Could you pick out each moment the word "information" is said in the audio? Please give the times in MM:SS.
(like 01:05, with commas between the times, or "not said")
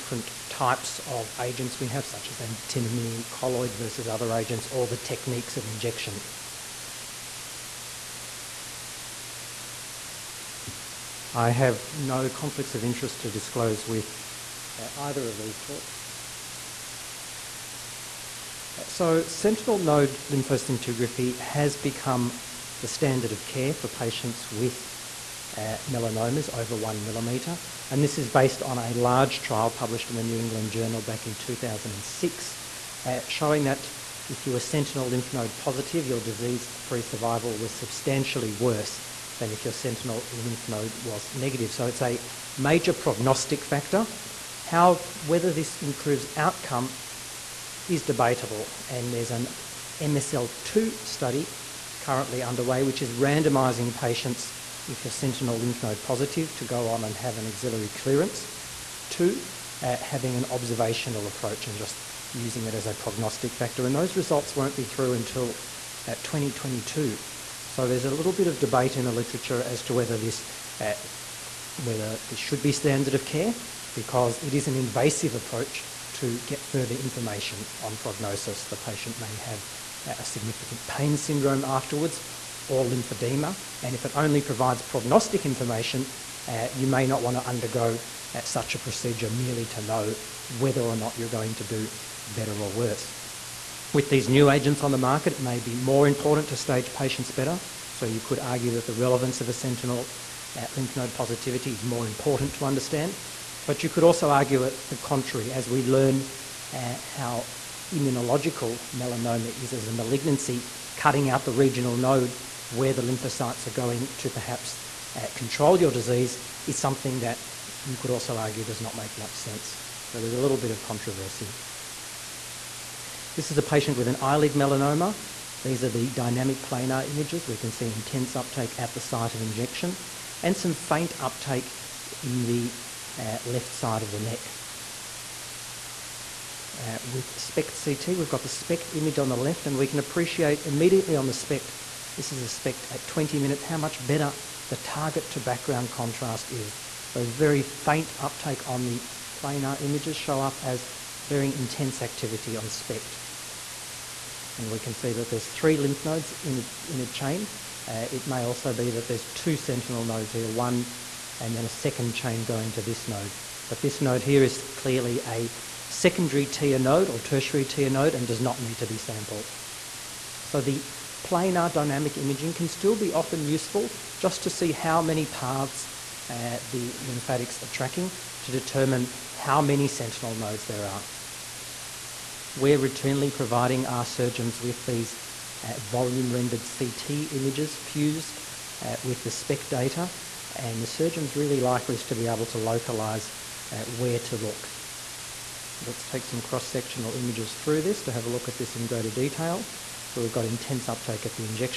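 01:16, 01:25.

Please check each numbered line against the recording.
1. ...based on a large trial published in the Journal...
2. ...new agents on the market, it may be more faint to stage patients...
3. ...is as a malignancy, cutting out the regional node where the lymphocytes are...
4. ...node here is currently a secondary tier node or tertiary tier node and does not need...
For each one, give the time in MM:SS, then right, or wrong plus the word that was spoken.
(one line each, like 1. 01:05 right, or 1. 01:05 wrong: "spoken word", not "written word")
1. 00:28 wrong: "New", not "Journal"
2. 01:34 wrong: "important", not "faint"
3. 01:49 right
4. 02:44 wrong: "clearly", not "currently".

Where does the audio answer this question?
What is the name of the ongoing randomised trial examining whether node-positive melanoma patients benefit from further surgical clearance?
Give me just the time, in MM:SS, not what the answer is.
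00:50.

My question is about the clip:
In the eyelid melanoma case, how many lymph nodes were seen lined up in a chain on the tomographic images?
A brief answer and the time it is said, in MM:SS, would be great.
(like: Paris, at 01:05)
3, at 02:35.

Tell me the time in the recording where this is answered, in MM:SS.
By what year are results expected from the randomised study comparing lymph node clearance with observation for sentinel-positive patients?
01:06.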